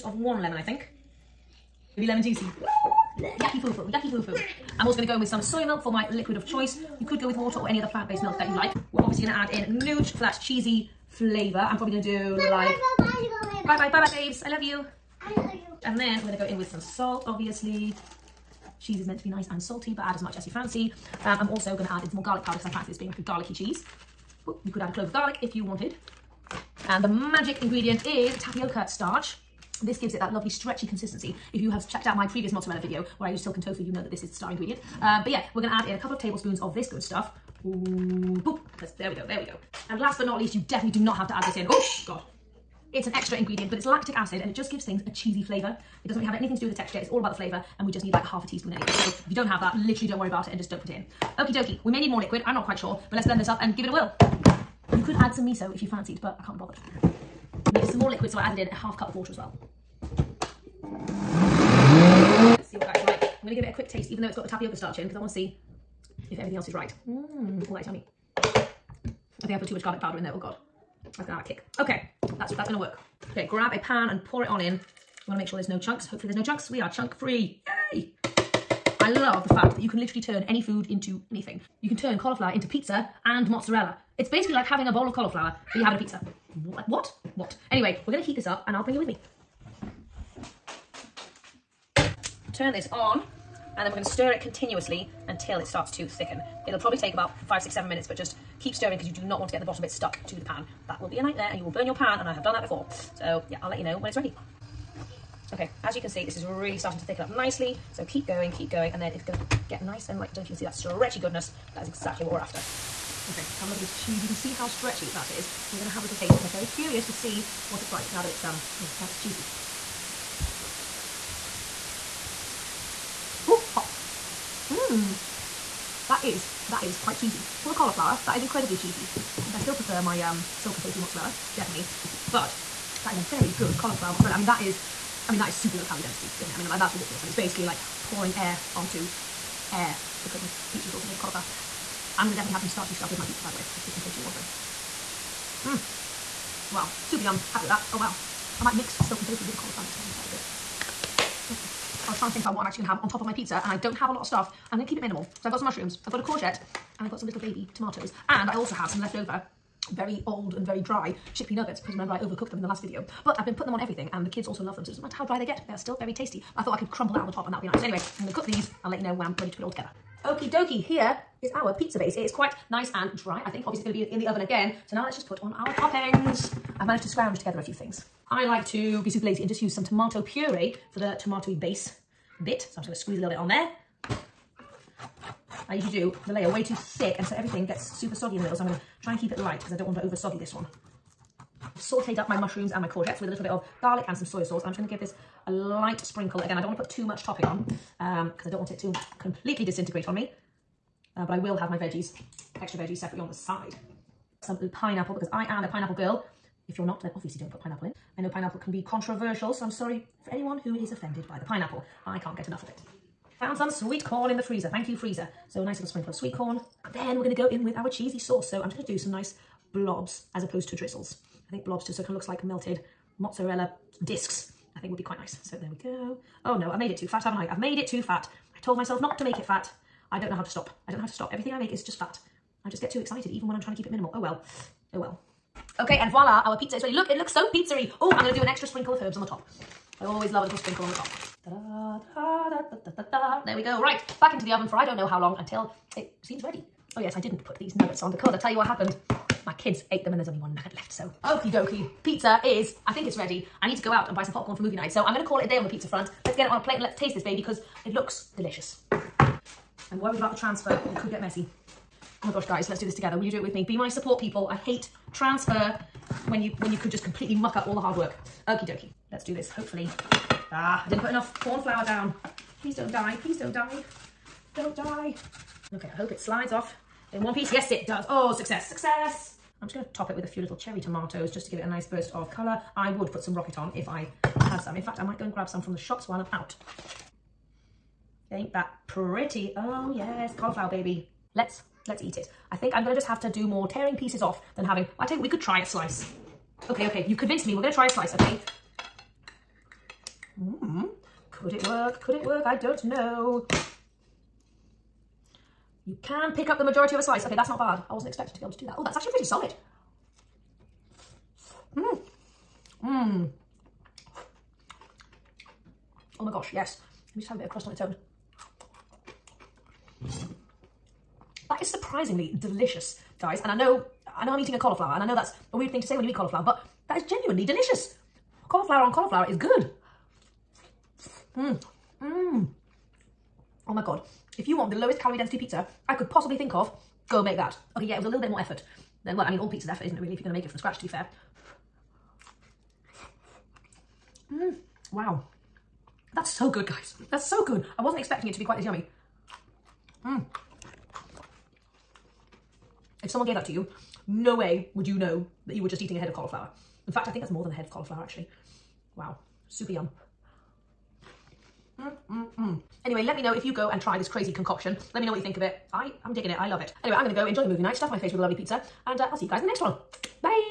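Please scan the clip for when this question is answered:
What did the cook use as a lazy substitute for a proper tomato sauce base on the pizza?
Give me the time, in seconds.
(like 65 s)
179 s.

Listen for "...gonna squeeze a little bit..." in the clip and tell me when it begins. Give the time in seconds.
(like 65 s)
182 s.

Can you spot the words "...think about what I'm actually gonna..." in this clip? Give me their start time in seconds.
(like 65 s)
152 s.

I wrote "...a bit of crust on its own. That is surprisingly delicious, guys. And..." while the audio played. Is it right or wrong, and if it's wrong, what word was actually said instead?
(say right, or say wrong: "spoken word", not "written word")
right.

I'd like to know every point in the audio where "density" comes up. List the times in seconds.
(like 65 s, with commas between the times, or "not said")
136 s, 335 s.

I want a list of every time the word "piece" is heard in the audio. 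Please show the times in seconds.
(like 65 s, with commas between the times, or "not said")
277 s, 293 s.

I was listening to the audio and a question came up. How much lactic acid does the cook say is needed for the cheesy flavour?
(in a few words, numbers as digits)
Half a teaspoon.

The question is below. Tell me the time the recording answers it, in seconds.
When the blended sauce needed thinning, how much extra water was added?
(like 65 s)
58 s.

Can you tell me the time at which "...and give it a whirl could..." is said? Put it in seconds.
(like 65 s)
53 s.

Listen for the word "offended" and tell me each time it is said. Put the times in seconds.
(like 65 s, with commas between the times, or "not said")
210 s.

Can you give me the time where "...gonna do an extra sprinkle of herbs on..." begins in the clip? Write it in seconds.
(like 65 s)
238 s.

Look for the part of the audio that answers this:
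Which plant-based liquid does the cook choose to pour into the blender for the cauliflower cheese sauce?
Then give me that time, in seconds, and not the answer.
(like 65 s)
5 s.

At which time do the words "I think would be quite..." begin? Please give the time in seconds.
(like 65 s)
224 s.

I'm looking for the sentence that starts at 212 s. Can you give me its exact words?
I can't get enough of it.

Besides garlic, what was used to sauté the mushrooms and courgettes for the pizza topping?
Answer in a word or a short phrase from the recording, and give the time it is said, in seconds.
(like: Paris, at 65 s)
Soy sauce, at 194 s.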